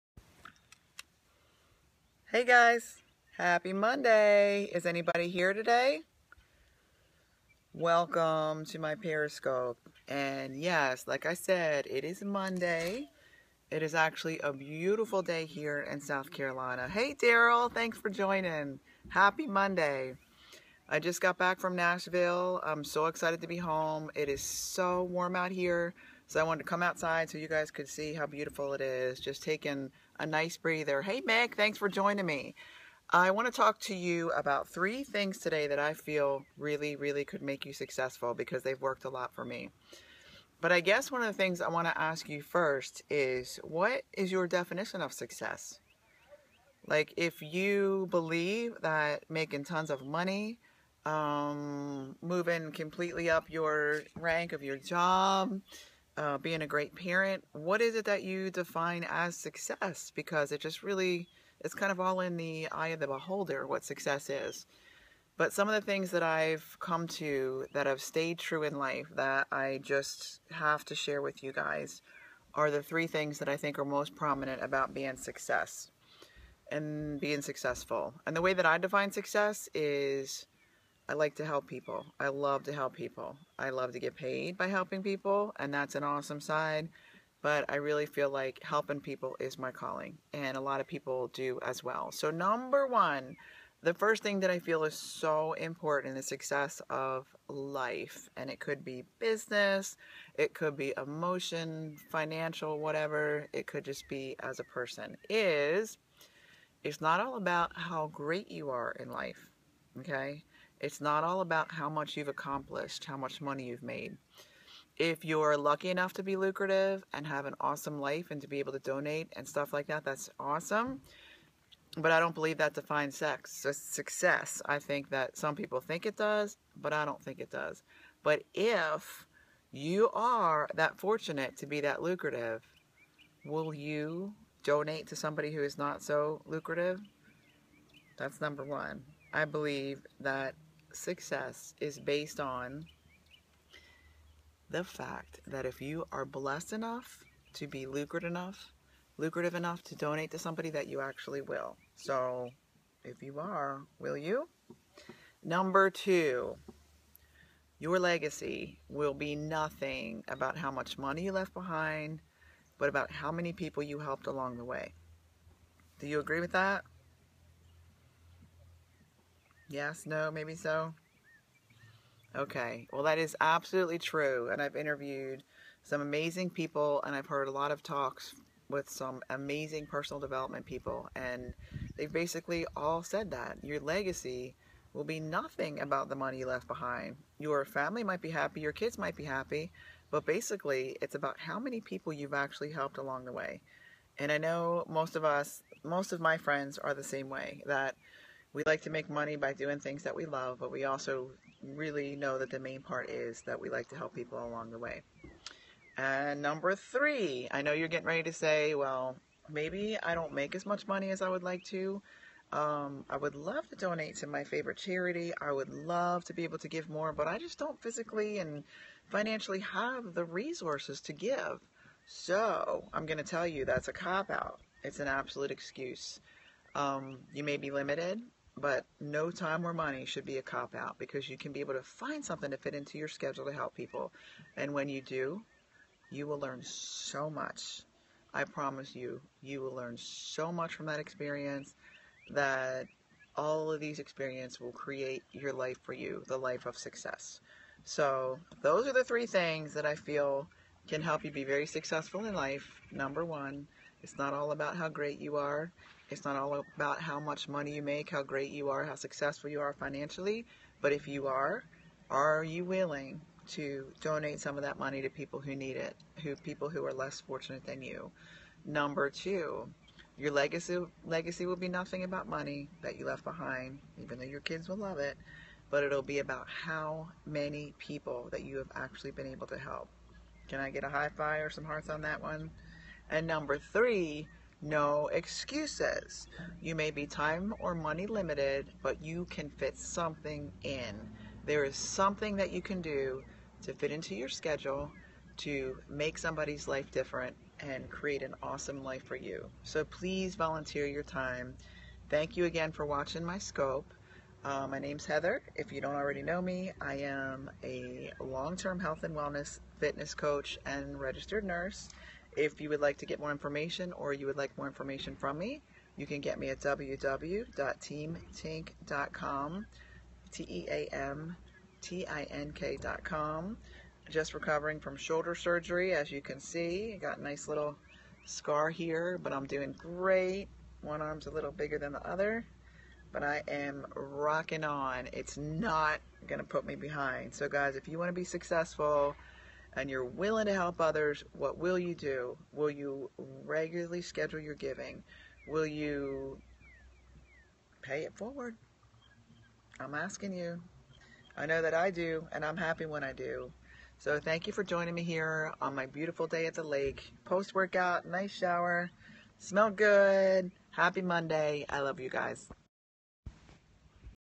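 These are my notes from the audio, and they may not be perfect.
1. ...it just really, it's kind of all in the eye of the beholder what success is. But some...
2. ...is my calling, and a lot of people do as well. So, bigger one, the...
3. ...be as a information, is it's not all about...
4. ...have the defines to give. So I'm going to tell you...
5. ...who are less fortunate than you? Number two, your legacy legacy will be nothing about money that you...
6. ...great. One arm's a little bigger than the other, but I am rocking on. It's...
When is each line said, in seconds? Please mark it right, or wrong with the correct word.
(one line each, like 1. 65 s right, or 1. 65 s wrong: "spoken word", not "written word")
1. 60 s right
2. 89 s wrong: "number", not "bigger"
3. 104 s wrong: "person", not "information"
4. 219 s wrong: "resources", not "defines"
5. 266 s right
6. 329 s right.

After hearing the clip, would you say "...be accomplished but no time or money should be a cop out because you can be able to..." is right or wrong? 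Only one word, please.
wrong.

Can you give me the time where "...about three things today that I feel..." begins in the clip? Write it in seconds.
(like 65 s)
34 s.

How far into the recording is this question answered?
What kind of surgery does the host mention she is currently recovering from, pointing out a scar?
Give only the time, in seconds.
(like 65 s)
324 s.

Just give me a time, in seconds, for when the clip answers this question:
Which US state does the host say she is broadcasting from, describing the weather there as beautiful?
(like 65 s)
15 s.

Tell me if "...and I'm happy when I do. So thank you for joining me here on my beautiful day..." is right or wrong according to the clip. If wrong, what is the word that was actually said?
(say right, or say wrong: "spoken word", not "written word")
right.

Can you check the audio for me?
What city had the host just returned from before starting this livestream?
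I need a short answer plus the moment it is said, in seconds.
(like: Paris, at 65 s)
Nashville, at 21 s.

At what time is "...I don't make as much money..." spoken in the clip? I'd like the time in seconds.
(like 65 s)
210 s.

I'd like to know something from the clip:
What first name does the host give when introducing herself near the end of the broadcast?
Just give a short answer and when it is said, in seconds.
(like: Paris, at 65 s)
Heather, at 305 s.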